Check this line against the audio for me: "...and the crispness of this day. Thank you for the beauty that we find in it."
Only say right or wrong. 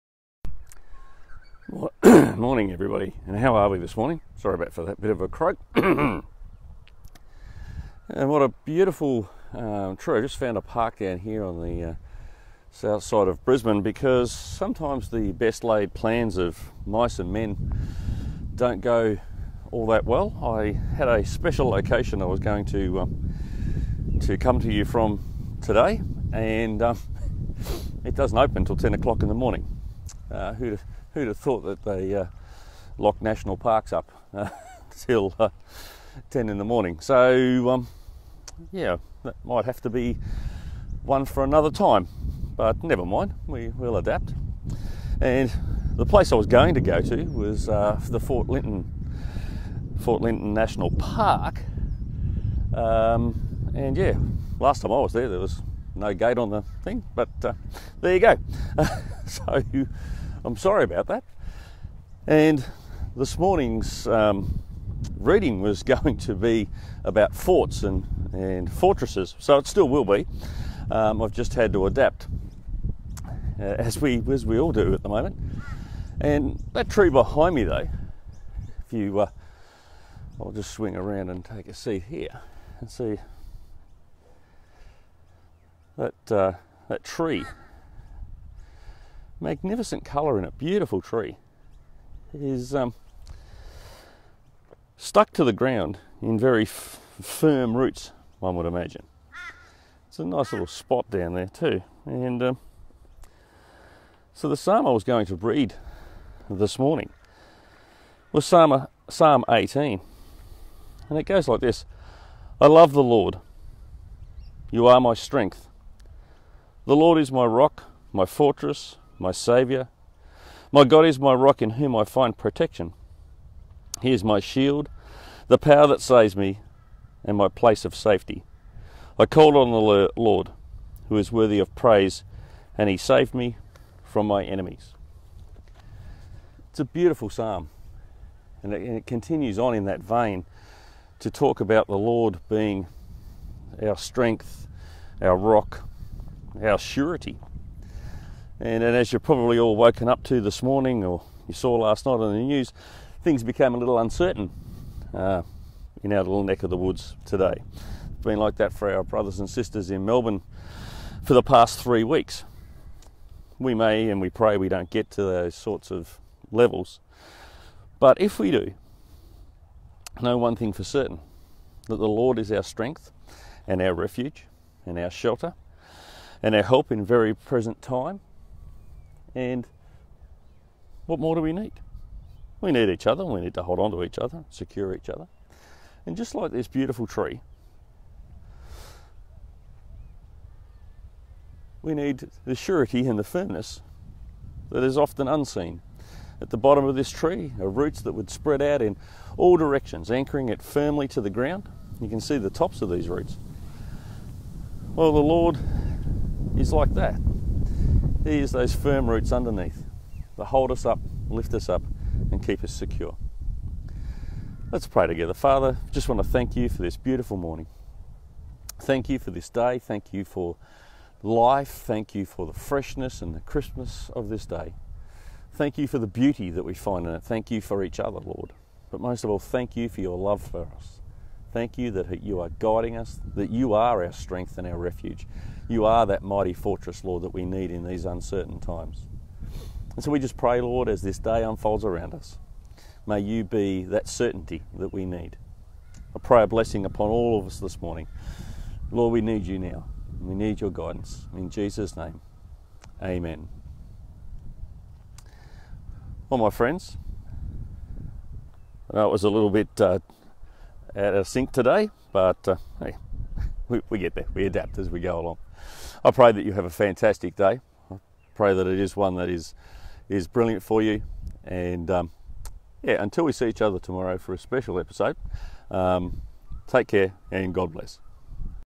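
right.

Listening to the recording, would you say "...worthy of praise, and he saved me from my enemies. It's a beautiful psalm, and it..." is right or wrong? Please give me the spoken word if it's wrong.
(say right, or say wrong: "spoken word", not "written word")
right.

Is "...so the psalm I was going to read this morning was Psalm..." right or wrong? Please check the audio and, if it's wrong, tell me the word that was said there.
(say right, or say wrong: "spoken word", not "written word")
right.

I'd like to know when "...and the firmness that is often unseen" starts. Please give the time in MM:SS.
03:13.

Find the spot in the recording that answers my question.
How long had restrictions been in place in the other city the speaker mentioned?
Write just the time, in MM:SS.
02:41.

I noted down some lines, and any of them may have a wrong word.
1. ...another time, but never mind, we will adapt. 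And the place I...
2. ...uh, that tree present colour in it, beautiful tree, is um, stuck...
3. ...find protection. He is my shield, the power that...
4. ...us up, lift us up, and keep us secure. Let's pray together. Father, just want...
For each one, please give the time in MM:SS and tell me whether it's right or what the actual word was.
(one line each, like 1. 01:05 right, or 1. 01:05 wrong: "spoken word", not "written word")
1. 00:41 right
2. 01:26 wrong: "magnificent", not "present"
3. 02:02 right
4. 03:30 right.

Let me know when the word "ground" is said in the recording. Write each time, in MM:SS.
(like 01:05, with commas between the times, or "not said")
01:35, 03:21.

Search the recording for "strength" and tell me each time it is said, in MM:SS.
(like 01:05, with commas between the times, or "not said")
01:55, 02:23, 02:52, 03:54.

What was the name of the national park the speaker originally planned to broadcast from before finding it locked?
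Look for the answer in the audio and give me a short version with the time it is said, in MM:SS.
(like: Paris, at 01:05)
Fort Lytton National Park, at 00:50.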